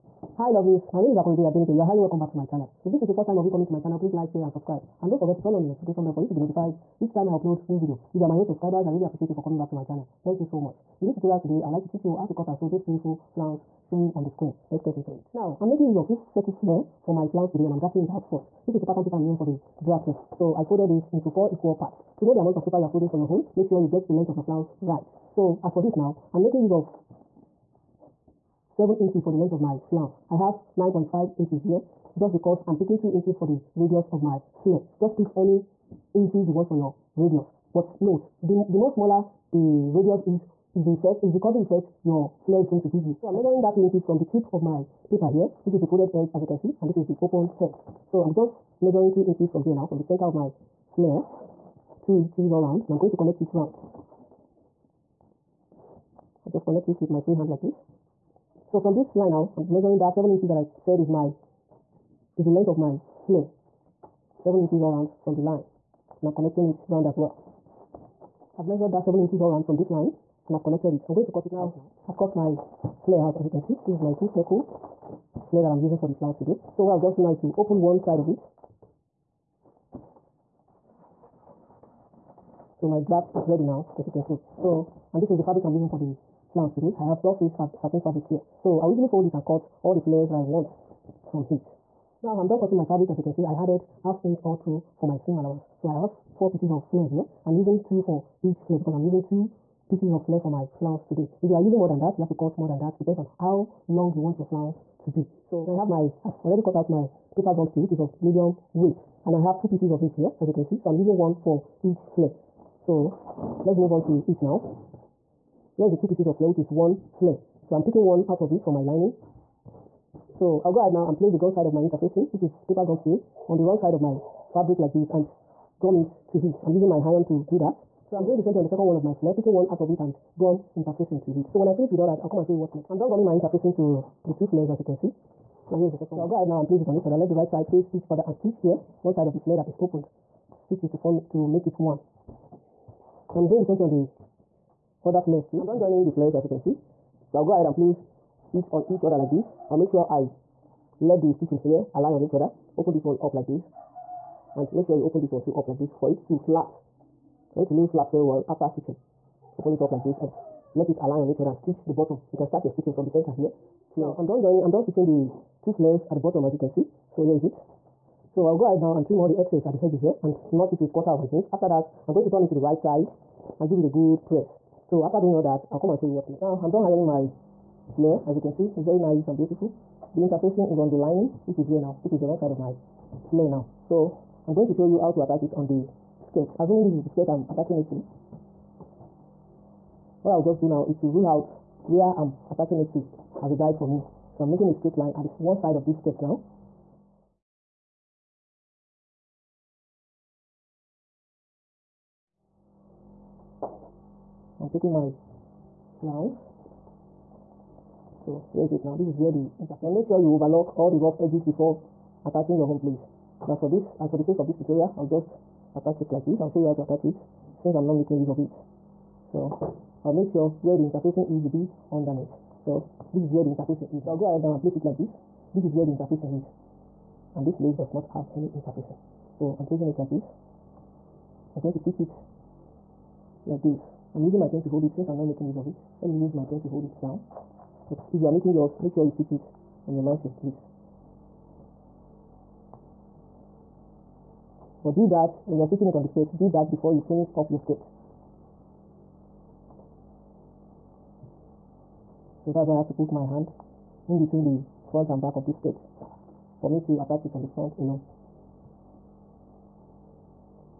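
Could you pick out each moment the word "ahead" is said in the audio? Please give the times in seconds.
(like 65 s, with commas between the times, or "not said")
120 s, 136 s, 147 s, 168 s, 224 s.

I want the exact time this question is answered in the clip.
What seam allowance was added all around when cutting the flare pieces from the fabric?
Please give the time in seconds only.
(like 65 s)
94 s.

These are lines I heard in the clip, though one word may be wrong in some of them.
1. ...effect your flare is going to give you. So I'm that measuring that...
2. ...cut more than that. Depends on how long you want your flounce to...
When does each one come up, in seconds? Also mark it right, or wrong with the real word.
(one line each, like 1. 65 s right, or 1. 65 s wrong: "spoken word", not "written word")
1. 41 s right
2. 102 s right.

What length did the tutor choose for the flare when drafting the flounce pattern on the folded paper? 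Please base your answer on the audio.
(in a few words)
7 inches.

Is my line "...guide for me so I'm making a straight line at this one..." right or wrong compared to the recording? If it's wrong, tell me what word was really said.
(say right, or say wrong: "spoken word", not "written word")
right.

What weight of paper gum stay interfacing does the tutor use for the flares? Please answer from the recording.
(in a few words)
Medium weight.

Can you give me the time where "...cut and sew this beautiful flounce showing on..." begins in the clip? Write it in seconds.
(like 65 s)
12 s.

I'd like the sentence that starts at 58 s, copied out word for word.
So from this line now, I'm measuring that 7 inches that I said is my is the length of my flare.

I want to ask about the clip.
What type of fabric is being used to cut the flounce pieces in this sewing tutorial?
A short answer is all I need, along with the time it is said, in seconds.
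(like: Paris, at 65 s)
Satin, at 87 s.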